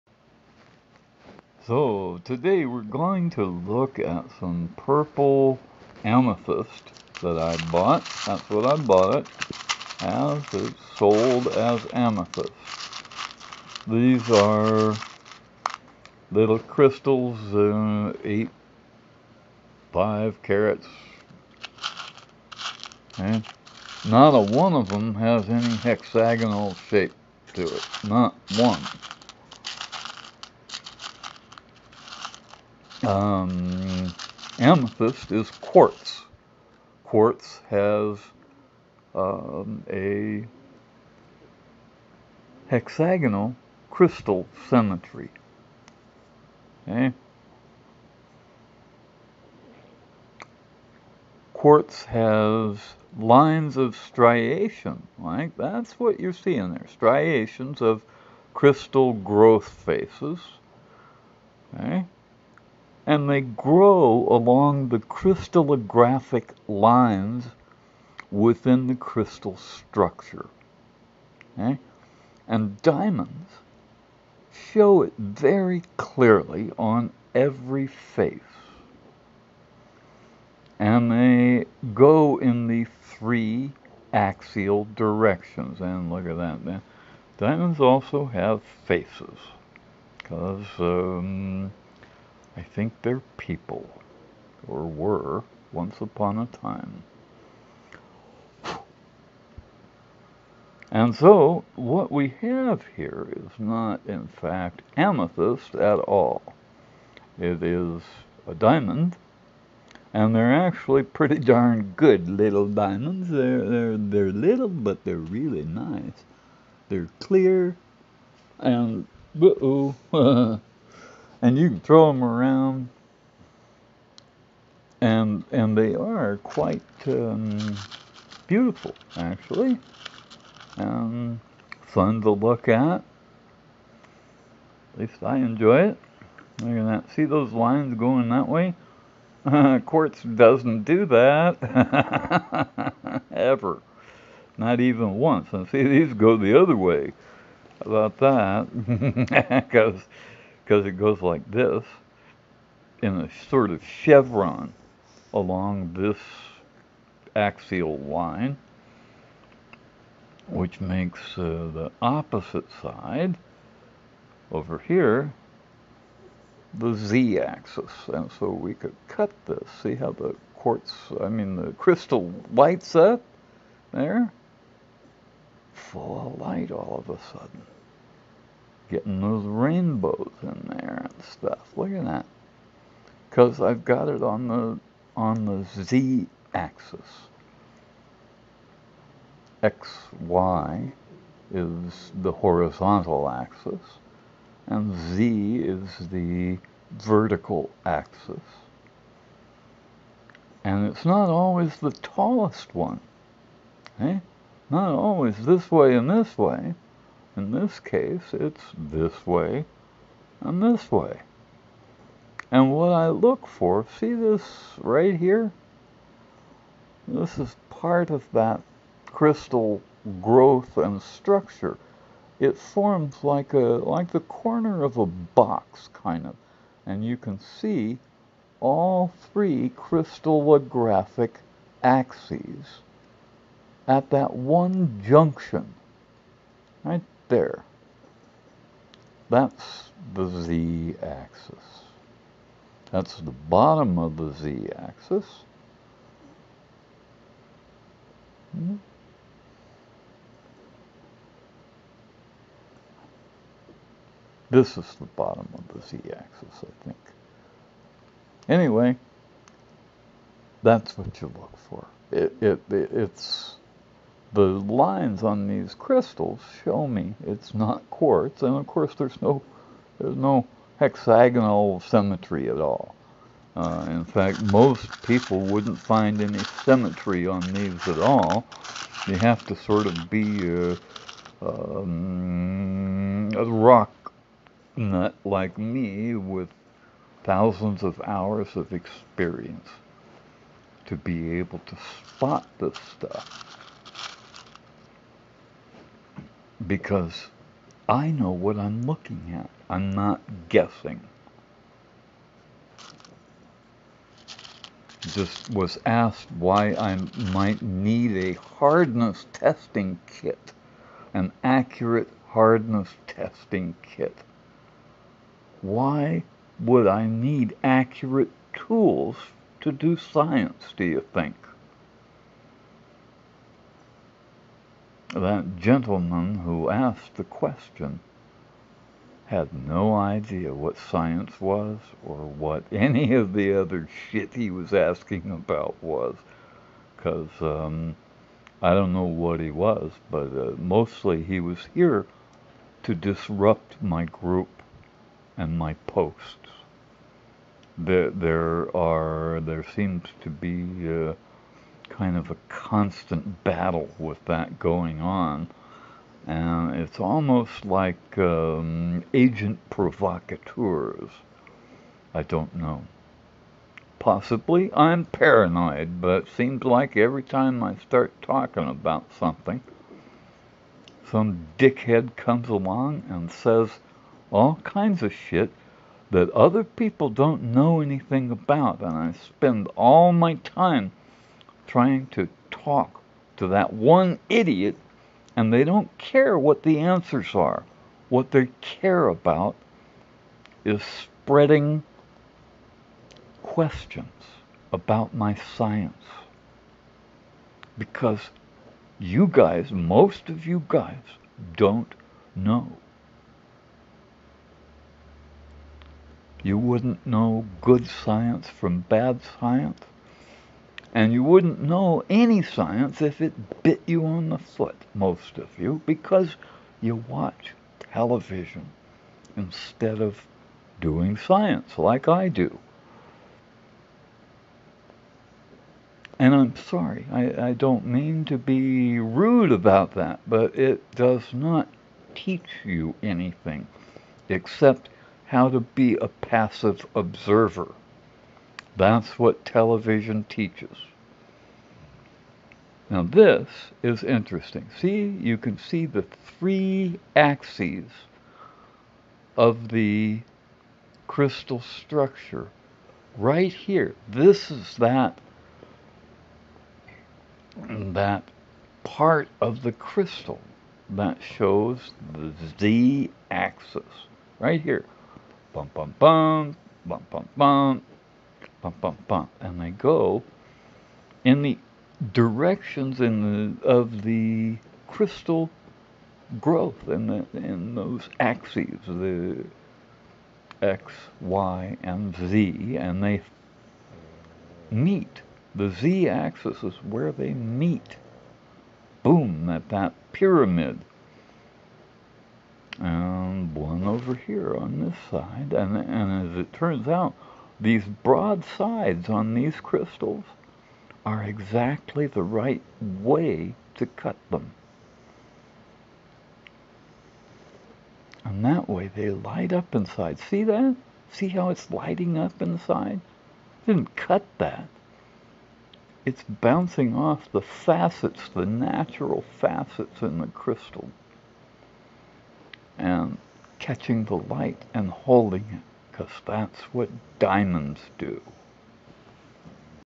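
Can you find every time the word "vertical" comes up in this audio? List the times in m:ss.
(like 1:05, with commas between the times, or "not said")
3:16.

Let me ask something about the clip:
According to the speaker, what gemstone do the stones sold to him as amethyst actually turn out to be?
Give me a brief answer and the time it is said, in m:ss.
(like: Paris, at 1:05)
diamond, at 1:48.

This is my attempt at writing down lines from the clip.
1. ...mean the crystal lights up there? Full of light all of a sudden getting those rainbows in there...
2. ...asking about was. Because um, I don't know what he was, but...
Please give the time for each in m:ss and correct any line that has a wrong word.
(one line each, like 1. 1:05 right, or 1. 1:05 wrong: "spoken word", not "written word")
1. 2:51 right
2. 5:34 right.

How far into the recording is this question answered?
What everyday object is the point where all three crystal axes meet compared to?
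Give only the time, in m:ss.
3:44.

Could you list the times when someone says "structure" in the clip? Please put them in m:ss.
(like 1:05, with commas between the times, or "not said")
1:09, 3:41, 7:31.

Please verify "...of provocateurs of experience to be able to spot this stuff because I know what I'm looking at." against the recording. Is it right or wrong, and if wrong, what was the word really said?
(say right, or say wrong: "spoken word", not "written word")
wrong: "hours", not "provocateurs".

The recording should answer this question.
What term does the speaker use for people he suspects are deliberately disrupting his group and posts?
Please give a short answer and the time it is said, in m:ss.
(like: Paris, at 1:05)
agent provocateurs, at 5:59.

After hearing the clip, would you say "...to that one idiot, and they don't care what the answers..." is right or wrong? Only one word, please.
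right.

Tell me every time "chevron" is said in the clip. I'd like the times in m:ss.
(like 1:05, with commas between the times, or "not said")
2:33.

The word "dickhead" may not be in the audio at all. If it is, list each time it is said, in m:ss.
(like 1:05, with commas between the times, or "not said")
6:11.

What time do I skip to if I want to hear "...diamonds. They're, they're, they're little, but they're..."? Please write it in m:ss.
1:52.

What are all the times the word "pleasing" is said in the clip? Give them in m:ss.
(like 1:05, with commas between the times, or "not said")
not said.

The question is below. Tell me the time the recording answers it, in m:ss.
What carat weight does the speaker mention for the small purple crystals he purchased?
0:18.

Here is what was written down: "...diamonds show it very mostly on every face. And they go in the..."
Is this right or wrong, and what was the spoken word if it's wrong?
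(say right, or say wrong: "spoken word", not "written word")
wrong: "clearly", not "mostly".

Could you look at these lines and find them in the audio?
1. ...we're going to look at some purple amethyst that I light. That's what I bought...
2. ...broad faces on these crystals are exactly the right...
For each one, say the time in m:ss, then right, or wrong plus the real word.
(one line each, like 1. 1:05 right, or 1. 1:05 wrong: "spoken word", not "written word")
1. 0:02 wrong: "bought", not "light"
2. 8:17 wrong: "sides", not "faces".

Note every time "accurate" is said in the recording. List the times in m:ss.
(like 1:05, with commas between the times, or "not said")
5:11, 5:17.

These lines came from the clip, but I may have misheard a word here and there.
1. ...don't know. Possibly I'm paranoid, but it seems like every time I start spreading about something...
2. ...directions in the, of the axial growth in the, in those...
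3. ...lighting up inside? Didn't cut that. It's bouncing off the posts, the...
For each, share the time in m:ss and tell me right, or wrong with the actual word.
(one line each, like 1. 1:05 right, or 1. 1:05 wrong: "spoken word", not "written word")
1. 6:02 wrong: "talking", not "spreading"
2. 7:52 wrong: "crystal", not "axial"
3. 8:31 wrong: "facets", not "posts".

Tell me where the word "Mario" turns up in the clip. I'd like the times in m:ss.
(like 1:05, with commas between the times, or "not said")
not said.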